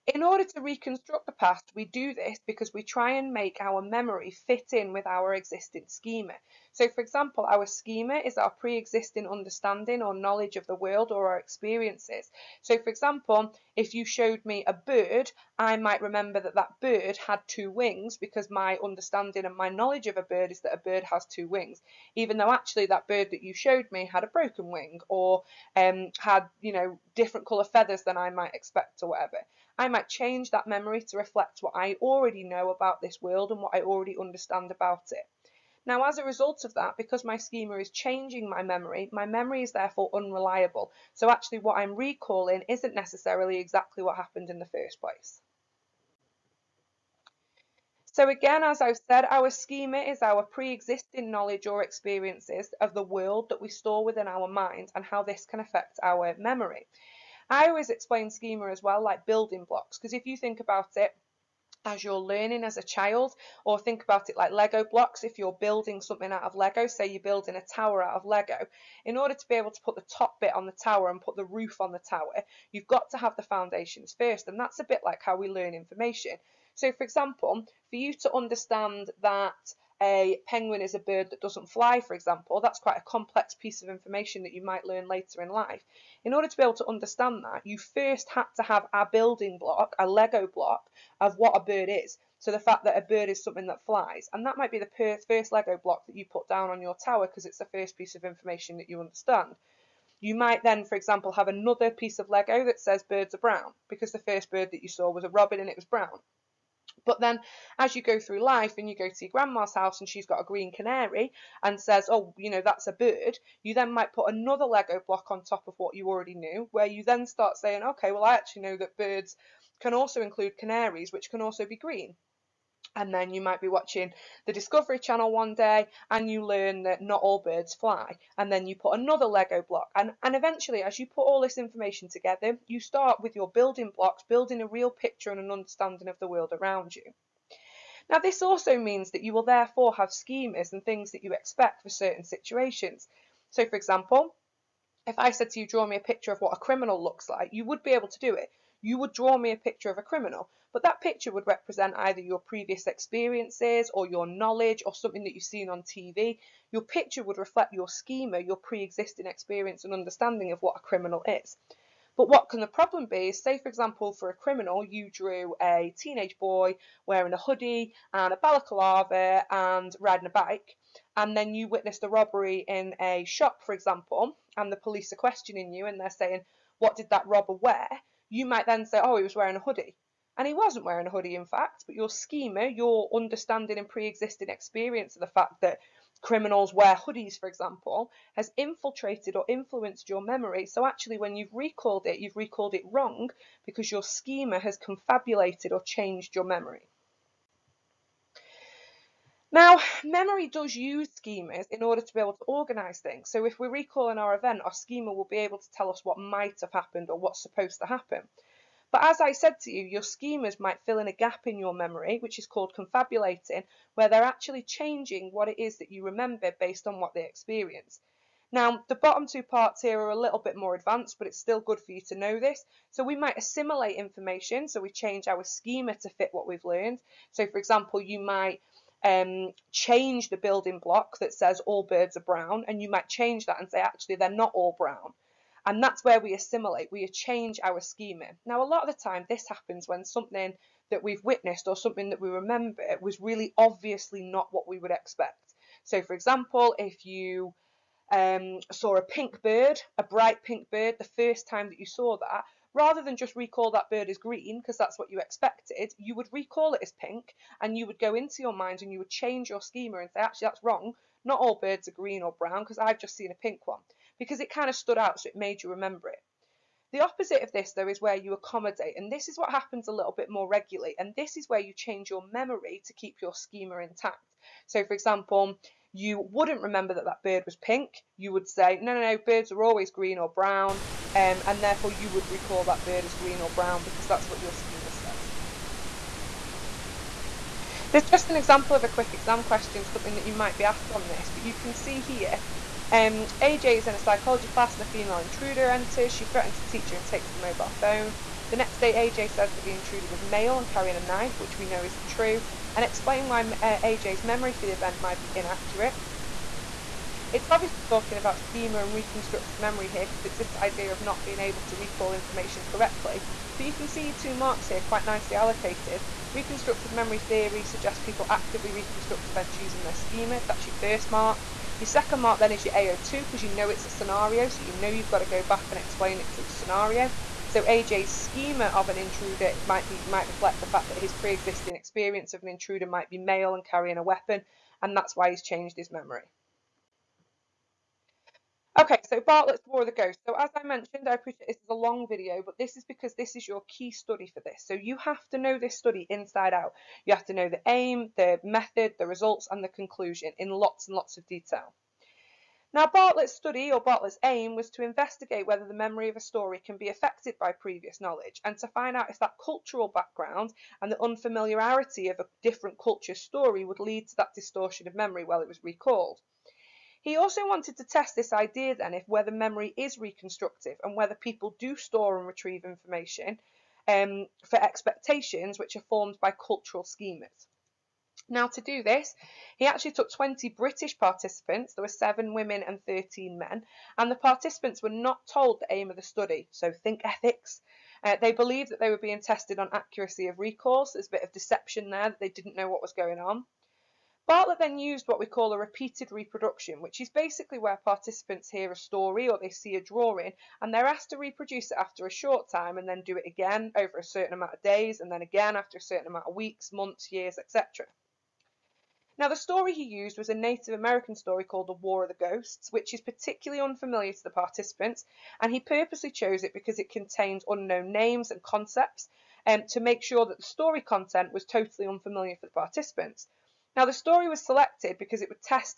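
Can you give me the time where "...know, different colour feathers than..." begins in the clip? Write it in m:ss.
0:26.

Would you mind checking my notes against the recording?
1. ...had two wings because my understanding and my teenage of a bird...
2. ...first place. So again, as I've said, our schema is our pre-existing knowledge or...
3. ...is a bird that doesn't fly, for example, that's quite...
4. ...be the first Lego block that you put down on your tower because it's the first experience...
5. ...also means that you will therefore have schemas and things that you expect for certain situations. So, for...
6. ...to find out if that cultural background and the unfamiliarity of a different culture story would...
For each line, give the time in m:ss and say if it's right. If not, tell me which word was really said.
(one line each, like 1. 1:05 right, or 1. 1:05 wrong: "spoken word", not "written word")
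1. 0:17 wrong: "knowledge", not "teenage"
2. 0:44 right
3. 1:20 right
4. 1:34 wrong: "piece", not "experience"
5. 2:18 right
6. 5:58 right.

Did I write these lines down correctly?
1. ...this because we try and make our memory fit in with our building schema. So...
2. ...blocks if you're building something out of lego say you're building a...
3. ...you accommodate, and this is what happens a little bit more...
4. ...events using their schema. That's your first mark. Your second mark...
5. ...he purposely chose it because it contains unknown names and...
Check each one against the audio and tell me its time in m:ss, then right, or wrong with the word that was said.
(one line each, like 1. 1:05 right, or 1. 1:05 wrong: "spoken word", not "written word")
1. 0:02 wrong: "existing", not "building"
2. 1:04 right
3. 4:28 right
4. 5:19 right
5. 6:55 right.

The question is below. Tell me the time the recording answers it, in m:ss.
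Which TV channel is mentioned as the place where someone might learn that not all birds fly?
2:04.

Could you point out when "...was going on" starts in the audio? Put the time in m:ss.
6:32.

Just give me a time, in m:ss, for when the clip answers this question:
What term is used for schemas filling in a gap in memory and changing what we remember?
3:32.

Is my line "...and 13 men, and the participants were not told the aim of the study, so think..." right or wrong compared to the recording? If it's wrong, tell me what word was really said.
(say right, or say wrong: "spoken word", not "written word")
right.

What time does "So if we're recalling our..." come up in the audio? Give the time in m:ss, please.
3:23.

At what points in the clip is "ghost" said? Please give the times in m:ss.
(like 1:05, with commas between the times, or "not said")
5:39, 6:52.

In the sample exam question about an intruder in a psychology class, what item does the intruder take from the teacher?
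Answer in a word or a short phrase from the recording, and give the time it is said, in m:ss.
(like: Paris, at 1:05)
Mobile phone, at 4:57.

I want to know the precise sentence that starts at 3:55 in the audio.
And that's where we assimilate, we change our schema.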